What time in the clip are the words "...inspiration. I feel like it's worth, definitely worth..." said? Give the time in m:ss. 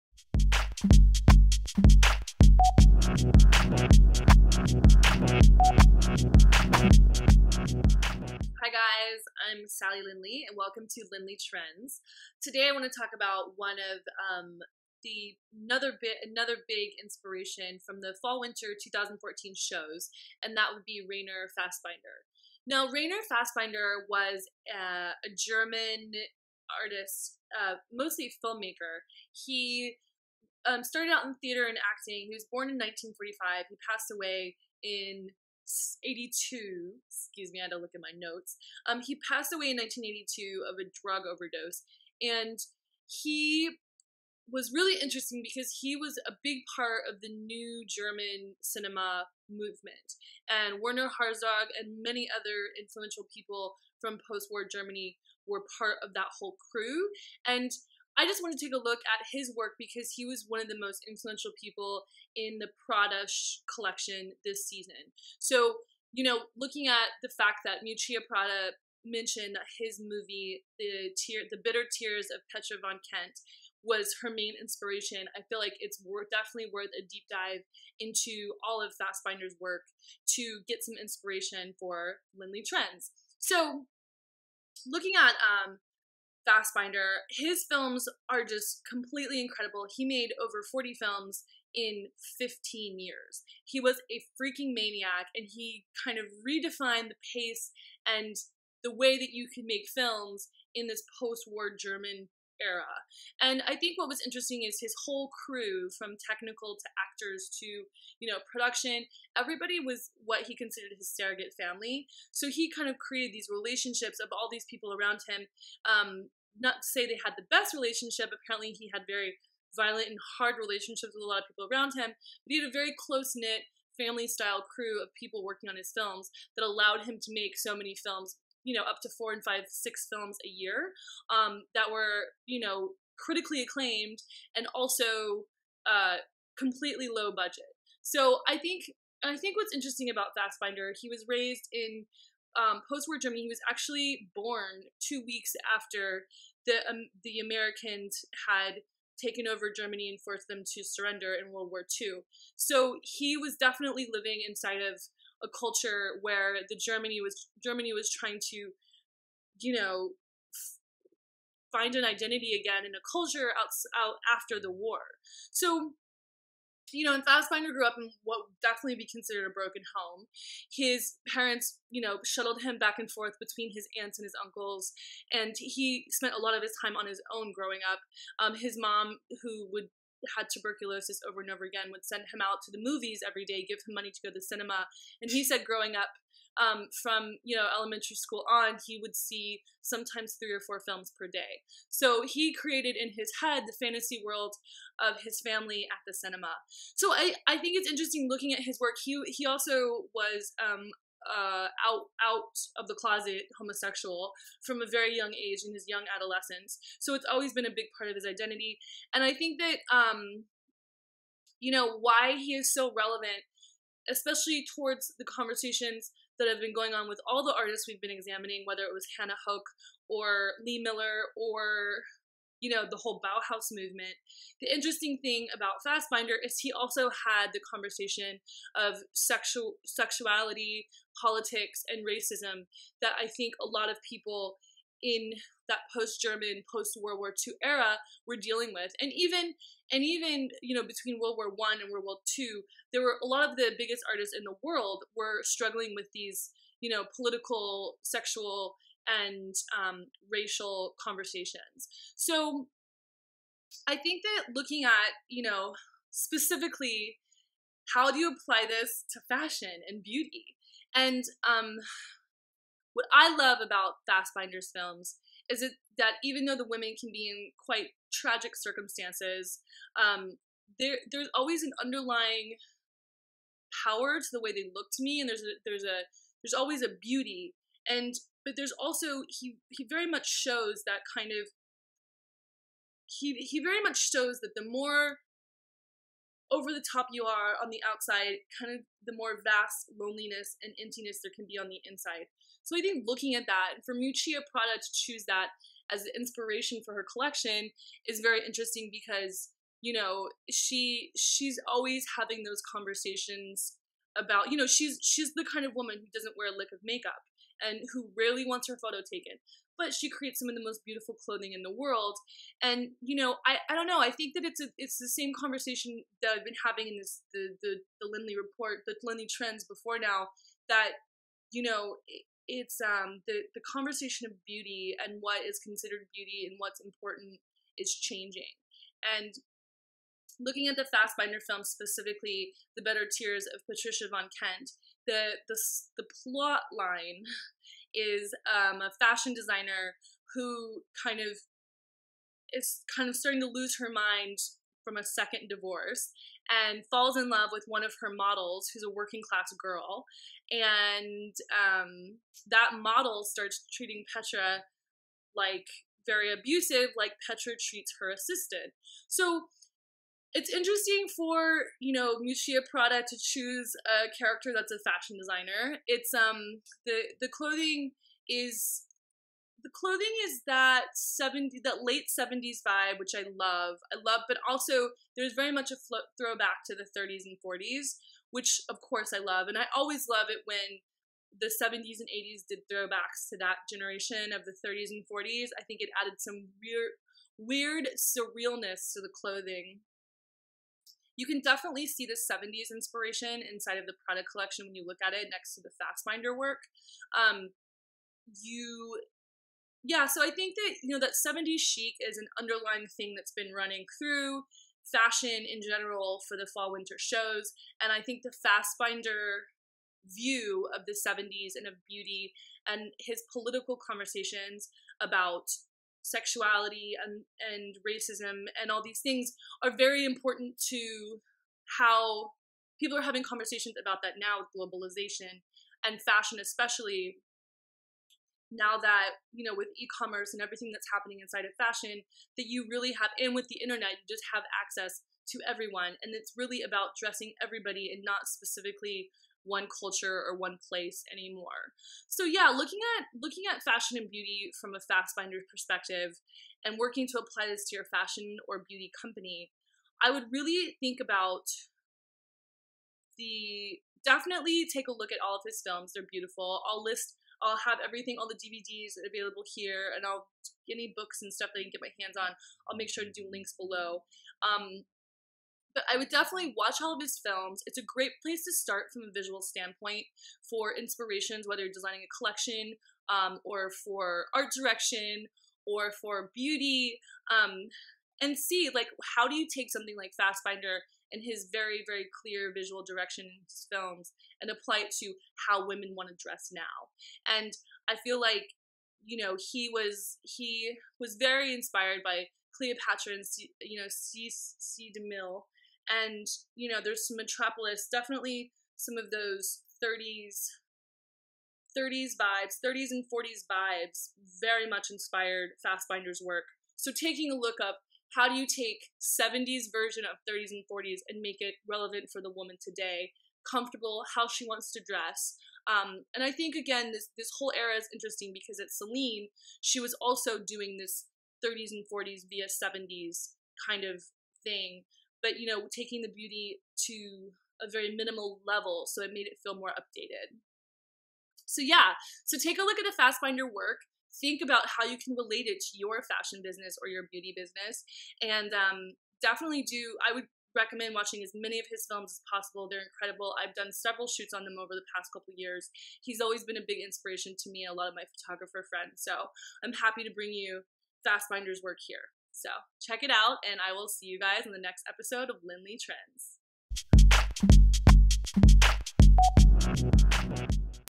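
1:14.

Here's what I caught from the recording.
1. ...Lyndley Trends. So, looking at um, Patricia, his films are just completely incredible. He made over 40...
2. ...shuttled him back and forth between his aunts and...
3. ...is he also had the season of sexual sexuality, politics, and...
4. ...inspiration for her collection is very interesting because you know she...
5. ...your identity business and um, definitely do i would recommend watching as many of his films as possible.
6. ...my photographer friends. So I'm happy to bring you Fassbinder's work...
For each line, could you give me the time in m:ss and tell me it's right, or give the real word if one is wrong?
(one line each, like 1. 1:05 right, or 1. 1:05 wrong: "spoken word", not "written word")
1. 1:22 wrong: "Fassbinder", not "Patricia"
2. 2:52 right
3. 3:46 wrong: "conversation", not "season"
4. 4:56 right
5. 8:56 wrong: "beauty", not "identity"
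6. 9:07 right.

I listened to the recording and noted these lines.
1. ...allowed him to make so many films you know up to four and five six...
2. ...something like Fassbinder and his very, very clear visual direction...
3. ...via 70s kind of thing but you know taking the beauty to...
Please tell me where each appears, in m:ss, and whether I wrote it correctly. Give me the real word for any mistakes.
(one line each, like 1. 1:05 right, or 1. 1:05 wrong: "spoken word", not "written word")
1. 2:06 right
2. 7:59 right
3. 8:42 right.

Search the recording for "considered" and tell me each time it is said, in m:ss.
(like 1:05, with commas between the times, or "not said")
1:50, 2:49, 5:25.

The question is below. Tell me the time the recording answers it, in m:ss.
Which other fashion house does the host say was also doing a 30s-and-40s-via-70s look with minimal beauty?
8:38.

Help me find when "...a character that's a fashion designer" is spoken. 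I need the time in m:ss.
6:03.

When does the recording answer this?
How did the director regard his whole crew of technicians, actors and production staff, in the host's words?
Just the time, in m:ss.
1:51.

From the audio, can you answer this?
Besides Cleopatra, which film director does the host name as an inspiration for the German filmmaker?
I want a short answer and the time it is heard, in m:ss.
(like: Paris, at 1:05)
C. DeMille, at 8:13.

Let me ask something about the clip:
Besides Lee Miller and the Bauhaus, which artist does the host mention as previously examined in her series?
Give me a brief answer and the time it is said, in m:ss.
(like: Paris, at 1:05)
Hannah Höch, at 3:39.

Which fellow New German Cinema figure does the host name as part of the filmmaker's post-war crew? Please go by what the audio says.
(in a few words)
Werner Herzog.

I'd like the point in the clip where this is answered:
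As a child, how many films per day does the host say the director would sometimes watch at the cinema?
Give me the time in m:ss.
3:10.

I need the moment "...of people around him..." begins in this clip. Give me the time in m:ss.
2:01.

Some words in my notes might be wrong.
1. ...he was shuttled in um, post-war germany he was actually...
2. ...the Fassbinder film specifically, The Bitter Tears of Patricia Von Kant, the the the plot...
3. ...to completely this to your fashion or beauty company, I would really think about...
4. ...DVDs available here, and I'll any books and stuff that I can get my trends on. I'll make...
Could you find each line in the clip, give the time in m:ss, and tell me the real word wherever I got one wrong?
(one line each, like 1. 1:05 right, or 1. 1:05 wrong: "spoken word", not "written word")
1. 2:20 wrong: "raised", not "shuttled"
2. 5:30 right
3. 7:27 wrong: "apply", not "completely"
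4. 7:38 wrong: "hands", not "trends".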